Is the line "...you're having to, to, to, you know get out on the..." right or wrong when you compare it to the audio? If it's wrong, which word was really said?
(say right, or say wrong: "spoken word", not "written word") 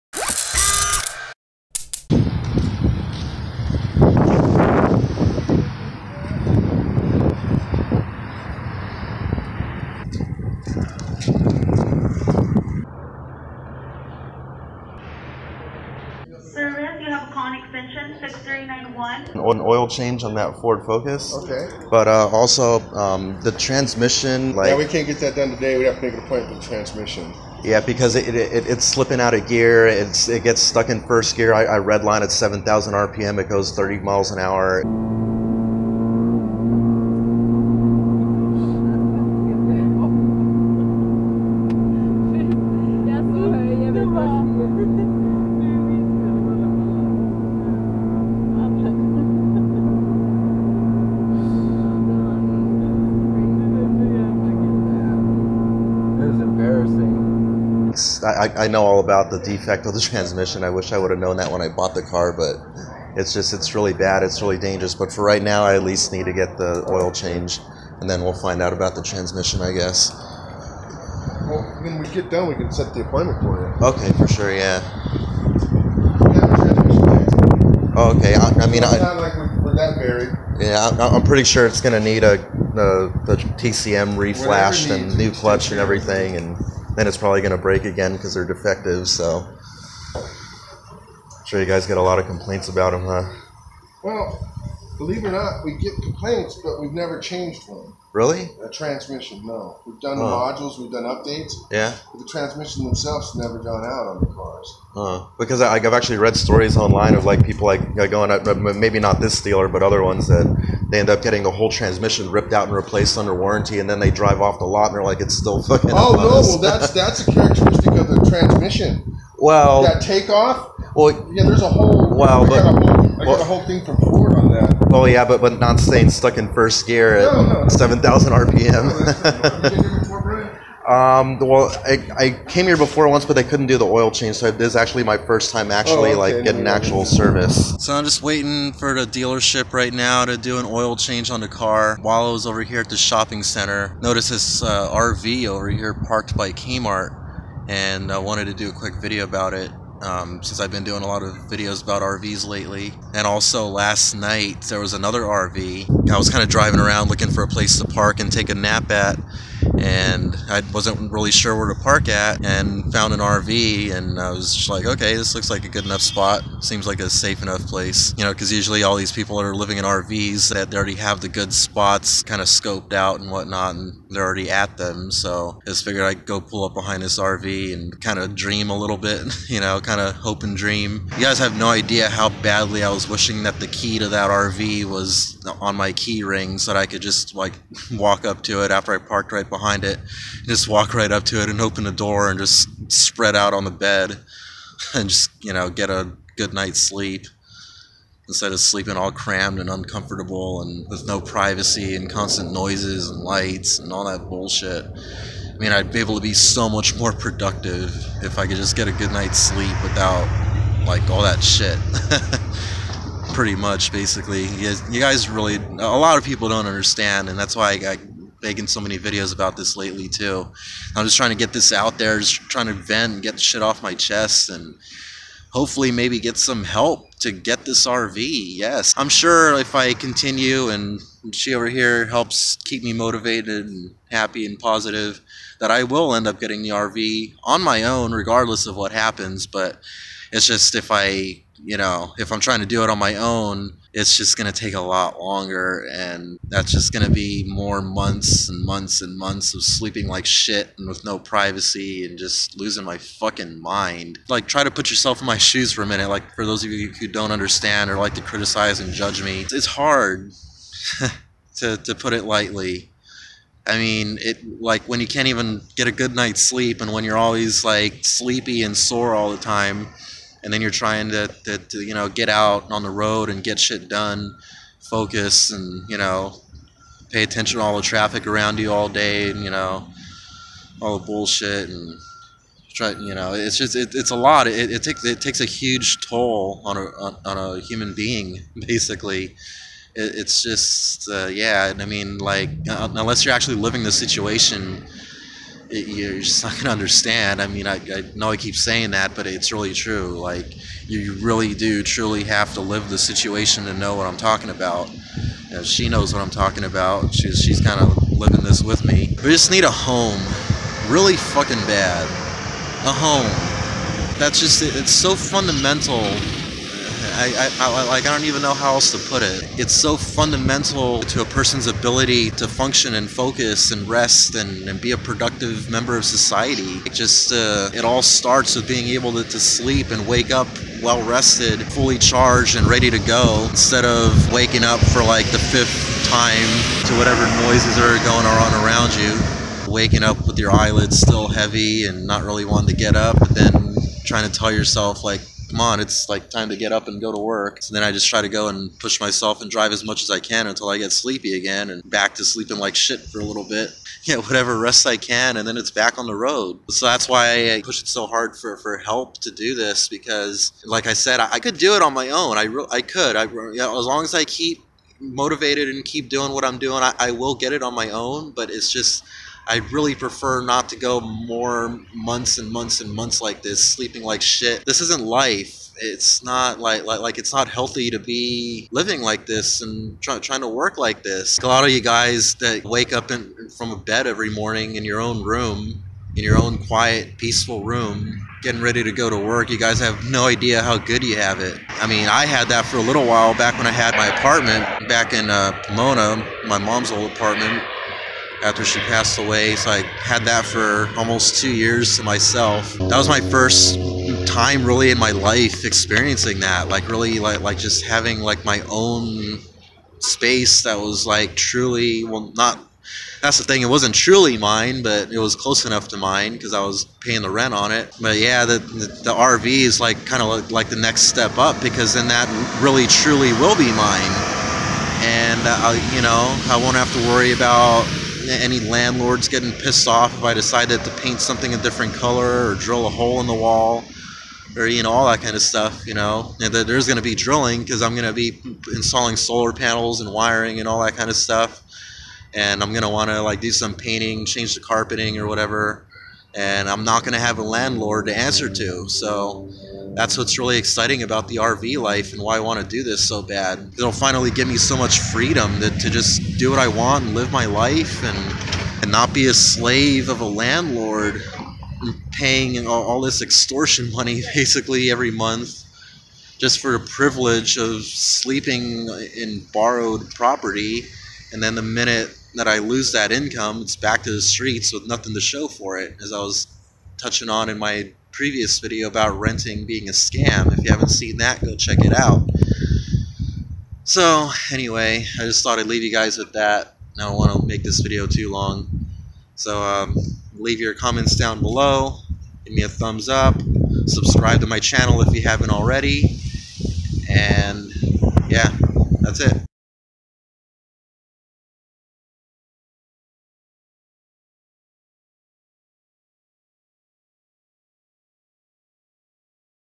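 wrong: "trying", not "having".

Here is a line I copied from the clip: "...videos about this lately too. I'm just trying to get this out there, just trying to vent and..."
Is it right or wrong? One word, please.
right.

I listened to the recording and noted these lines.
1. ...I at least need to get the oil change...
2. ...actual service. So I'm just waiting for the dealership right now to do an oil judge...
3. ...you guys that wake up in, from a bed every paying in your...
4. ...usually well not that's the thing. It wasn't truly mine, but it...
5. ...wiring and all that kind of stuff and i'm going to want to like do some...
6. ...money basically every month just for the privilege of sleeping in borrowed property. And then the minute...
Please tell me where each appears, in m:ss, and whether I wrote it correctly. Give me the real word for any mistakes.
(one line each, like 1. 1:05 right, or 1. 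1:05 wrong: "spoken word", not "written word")
1. 1:05 right
2. 2:16 wrong: "change", not "judge"
3. 6:21 wrong: "morning", not "paying"
4. 6:51 wrong: "truly", not "usually"
5. 7:20 right
6. 7:43 right.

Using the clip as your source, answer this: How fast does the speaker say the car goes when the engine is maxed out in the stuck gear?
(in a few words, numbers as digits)
30 miles an hour.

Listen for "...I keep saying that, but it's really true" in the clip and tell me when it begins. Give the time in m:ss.
4:58.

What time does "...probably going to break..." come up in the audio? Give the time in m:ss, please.
1:27.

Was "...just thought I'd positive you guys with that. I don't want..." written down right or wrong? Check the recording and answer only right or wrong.
wrong.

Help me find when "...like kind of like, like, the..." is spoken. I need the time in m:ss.
6:59.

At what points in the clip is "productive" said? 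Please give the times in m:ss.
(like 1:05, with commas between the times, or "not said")
3:27, 5:24.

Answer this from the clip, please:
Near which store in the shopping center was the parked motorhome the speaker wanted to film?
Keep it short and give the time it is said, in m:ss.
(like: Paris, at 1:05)
Kmart, at 2:26.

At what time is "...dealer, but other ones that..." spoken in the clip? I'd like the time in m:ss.
1:49.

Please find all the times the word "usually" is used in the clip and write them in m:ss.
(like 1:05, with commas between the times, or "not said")
2:48.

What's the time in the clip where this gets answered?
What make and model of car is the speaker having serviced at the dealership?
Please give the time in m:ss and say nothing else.
0:20.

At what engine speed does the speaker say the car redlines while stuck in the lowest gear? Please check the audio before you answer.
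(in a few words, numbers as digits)
7,000 RPM.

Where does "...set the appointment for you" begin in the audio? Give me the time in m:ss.
1:12.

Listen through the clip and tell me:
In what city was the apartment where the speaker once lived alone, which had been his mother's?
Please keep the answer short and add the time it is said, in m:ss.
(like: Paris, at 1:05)
Pomona, at 6:35.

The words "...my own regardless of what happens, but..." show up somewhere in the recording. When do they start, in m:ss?
3:57.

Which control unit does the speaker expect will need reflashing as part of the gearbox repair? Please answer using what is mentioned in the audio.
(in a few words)
TCM.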